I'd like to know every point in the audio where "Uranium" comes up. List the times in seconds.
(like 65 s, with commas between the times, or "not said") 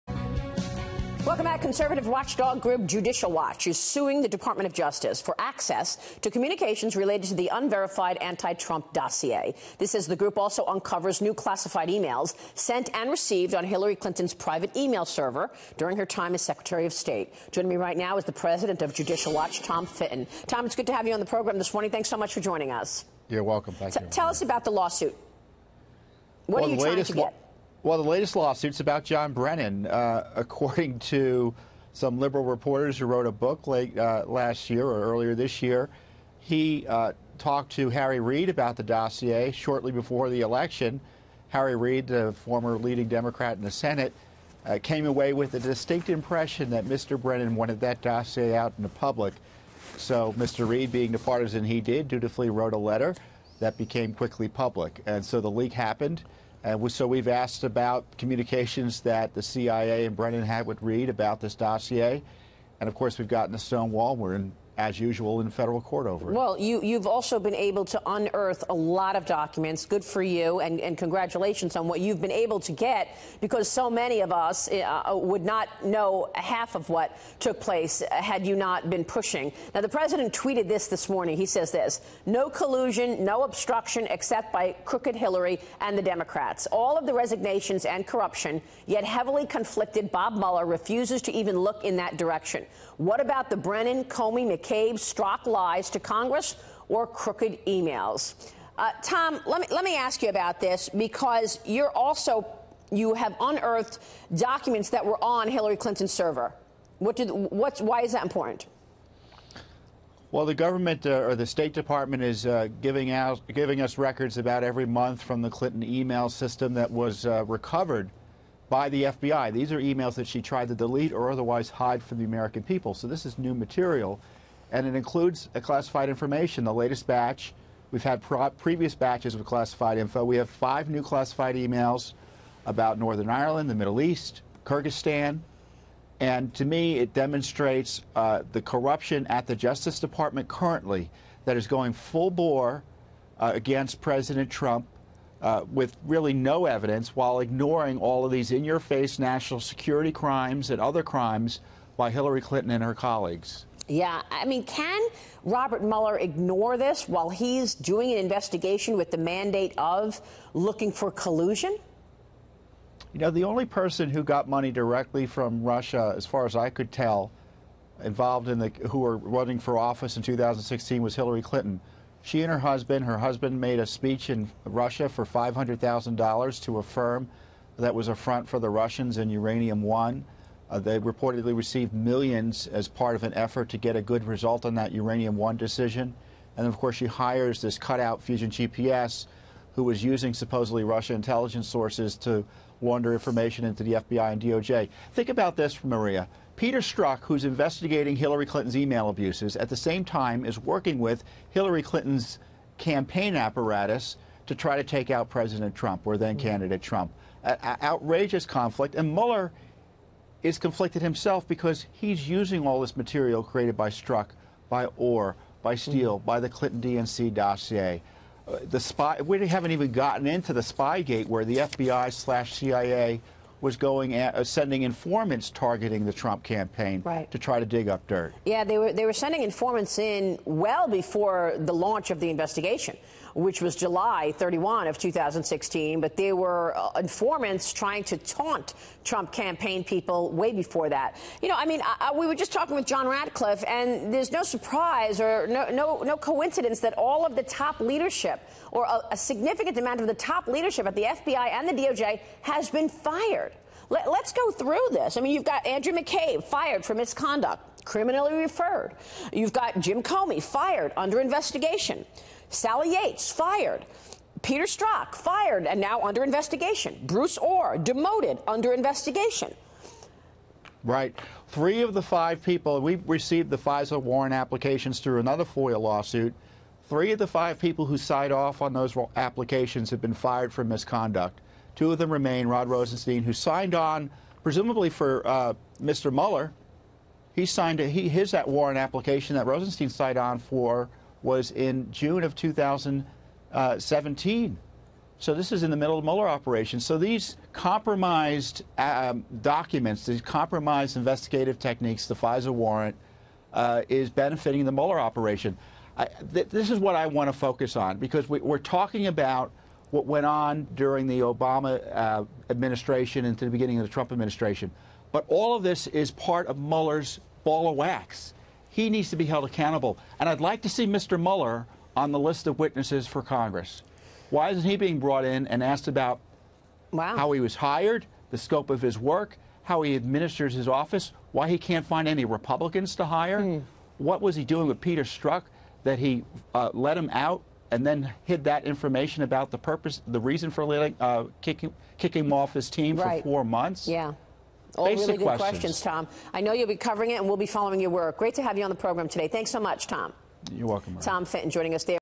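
179 s, 184 s.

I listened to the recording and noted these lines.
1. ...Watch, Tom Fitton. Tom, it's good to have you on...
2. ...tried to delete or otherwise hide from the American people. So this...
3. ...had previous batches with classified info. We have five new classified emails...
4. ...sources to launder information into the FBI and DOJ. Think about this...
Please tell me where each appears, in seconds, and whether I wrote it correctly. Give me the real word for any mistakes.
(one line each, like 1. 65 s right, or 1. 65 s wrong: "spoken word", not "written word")
1. 19 s right
2. 120 s right
3. 128 s right
4. 191 s right.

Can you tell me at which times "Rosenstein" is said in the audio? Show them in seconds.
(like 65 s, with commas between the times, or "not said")
282 s, 289 s.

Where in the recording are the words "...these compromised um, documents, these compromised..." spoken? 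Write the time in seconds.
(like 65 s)
296 s.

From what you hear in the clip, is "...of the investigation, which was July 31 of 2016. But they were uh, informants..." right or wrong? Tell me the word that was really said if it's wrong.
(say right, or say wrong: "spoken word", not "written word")
right.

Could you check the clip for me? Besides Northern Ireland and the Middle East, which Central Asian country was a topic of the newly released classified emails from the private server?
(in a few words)
Kyrgyzstan.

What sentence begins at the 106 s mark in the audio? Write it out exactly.
What did, what's, why is that important?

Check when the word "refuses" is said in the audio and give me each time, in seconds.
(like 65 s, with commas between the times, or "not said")
90 s.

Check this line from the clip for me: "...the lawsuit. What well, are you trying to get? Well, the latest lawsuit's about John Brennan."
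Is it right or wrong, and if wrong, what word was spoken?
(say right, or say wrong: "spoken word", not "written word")
right.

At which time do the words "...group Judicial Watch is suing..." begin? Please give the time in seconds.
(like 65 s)
2 s.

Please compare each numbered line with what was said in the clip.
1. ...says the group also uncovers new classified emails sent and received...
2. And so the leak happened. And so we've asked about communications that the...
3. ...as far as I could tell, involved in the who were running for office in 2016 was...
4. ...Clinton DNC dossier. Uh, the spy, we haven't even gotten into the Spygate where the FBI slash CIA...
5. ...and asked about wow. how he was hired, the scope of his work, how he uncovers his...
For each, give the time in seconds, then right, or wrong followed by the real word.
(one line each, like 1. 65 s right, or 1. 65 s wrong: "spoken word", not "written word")
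1. 9 s right
2. 55 s right
3. 166 s right
4. 216 s right
5. 325 s wrong: "administers", not "uncovers".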